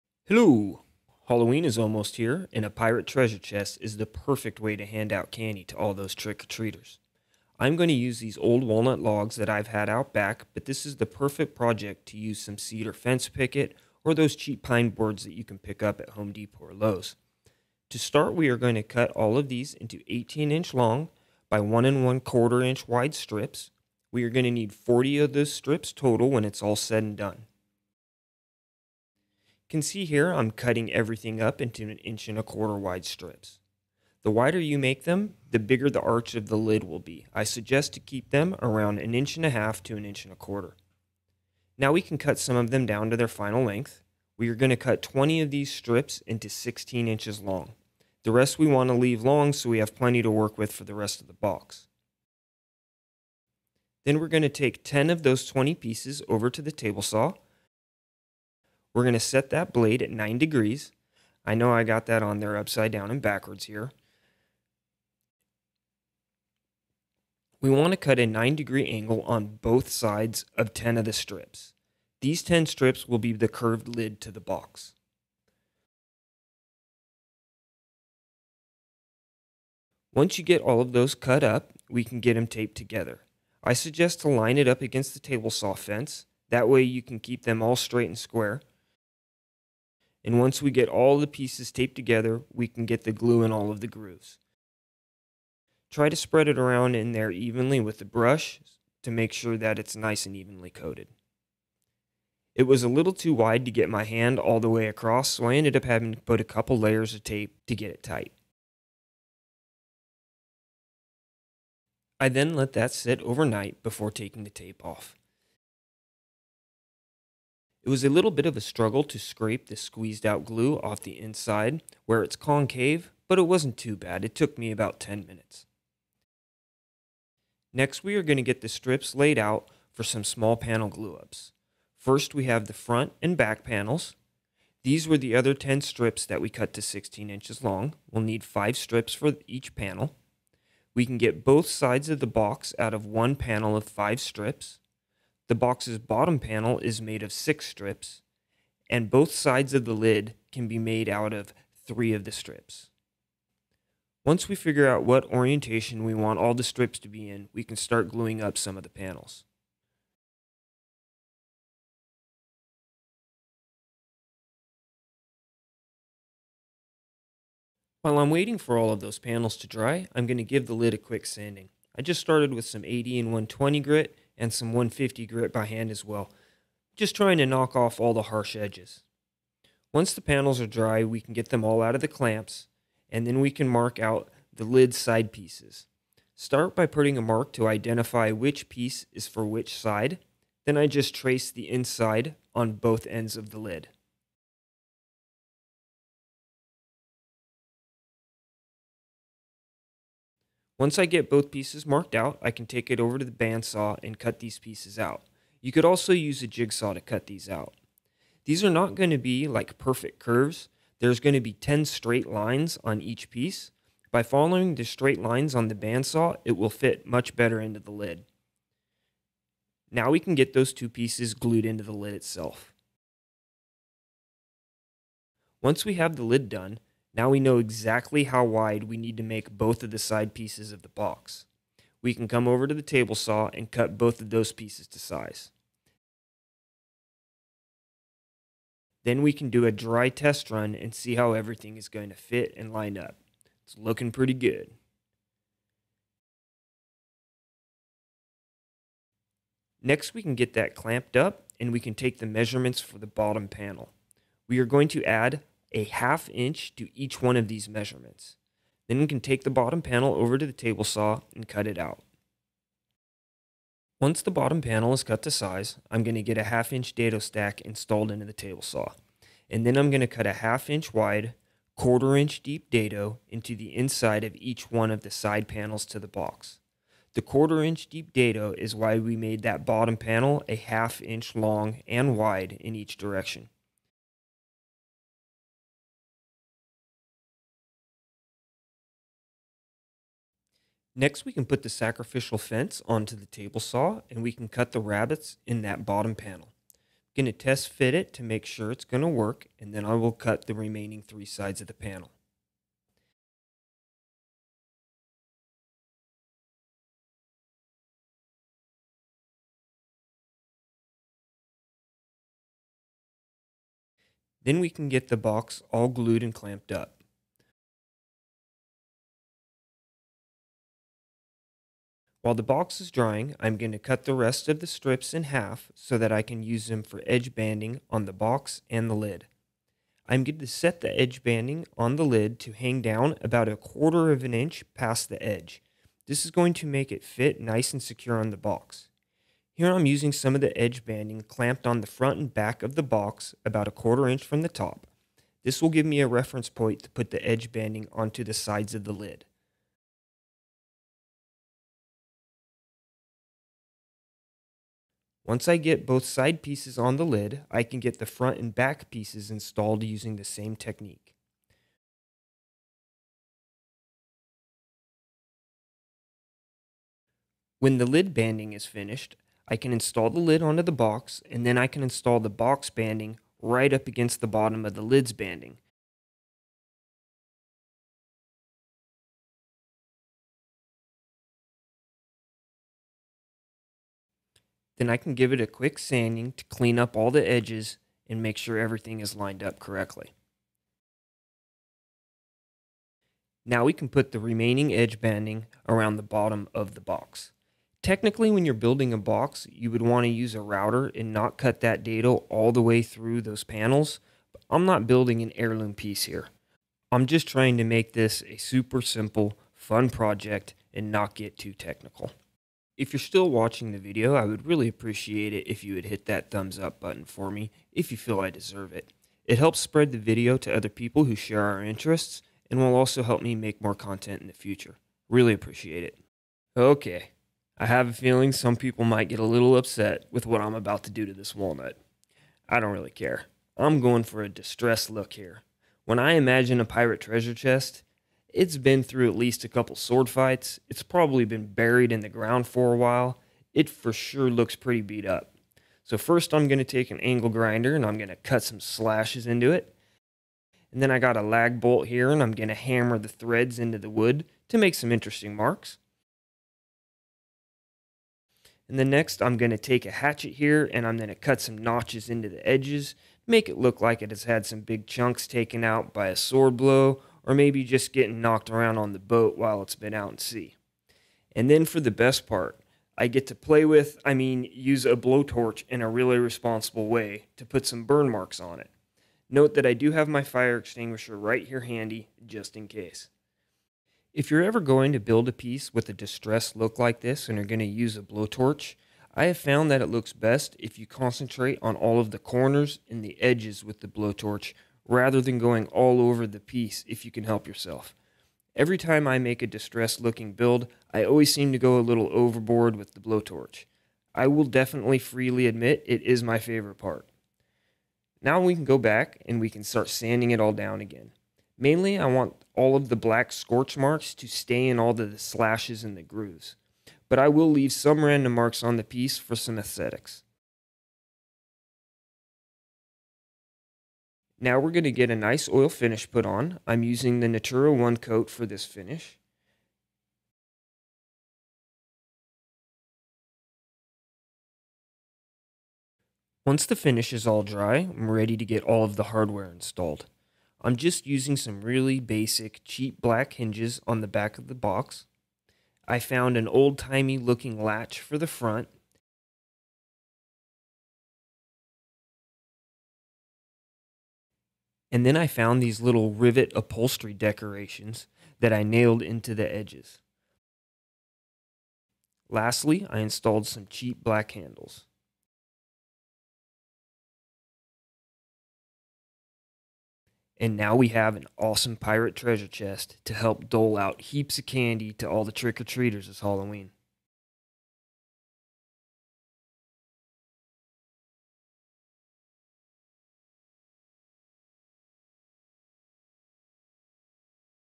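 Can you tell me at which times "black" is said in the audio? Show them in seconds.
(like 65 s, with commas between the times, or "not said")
512 s, 542 s, 564 s.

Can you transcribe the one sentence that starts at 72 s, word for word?
These 10 strips will be the curved lid to the box.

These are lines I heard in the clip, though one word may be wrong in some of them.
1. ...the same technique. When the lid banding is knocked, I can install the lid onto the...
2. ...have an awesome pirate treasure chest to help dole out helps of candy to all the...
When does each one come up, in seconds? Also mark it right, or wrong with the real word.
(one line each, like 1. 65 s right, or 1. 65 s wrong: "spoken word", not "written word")
1. 360 s wrong: "finished", not "knocked"
2. 570 s wrong: "heaps", not "helps".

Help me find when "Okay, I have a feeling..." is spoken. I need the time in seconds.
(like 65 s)
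426 s.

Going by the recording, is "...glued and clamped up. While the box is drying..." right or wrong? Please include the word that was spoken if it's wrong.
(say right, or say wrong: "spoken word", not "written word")
right.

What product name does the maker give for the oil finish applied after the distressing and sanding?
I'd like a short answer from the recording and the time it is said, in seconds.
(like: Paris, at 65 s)
Natura 1 coat, at 527 s.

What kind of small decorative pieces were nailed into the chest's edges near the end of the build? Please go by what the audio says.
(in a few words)
rivet upholstery decorations.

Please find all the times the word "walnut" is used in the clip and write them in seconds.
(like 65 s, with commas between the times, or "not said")
8 s, 431 s.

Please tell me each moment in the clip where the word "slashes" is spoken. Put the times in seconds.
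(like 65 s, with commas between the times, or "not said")
448 s, 515 s.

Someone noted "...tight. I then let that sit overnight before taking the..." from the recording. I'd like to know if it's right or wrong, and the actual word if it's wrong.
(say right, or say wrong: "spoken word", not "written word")
right.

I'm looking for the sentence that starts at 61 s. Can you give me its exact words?
I know I got that on there upside down and backwards here.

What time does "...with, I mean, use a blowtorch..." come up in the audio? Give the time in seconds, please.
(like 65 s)
473 s.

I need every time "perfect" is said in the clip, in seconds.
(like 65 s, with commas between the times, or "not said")
4 s, 11 s, 209 s.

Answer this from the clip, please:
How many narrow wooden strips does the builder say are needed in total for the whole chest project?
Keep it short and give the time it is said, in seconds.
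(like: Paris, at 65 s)
40, at 24 s.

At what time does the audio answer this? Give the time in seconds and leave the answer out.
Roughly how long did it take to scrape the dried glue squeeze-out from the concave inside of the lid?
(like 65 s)
124 s.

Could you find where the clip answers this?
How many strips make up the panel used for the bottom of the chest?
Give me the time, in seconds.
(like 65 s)
147 s.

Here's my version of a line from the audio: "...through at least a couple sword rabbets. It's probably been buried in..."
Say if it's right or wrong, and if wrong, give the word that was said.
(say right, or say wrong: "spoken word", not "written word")
wrong: "fights", not "rabbets".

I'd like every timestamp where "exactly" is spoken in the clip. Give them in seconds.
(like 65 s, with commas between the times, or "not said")
227 s.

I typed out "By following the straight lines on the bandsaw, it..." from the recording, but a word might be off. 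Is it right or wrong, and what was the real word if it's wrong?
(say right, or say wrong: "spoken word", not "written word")
right.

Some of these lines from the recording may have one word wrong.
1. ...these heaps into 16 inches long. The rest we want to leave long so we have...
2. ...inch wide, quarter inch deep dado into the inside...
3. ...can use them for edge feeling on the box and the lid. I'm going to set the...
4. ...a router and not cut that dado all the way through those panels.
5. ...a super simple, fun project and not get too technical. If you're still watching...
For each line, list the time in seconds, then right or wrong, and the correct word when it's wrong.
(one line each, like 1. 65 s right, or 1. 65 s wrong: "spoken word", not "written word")
1. 45 s wrong: "strips", not "heaps"
2. 270 s right
3. 326 s wrong: "banding", not "feeling"
4. 400 s right
5. 408 s right.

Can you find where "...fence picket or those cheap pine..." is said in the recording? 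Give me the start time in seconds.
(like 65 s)
12 s.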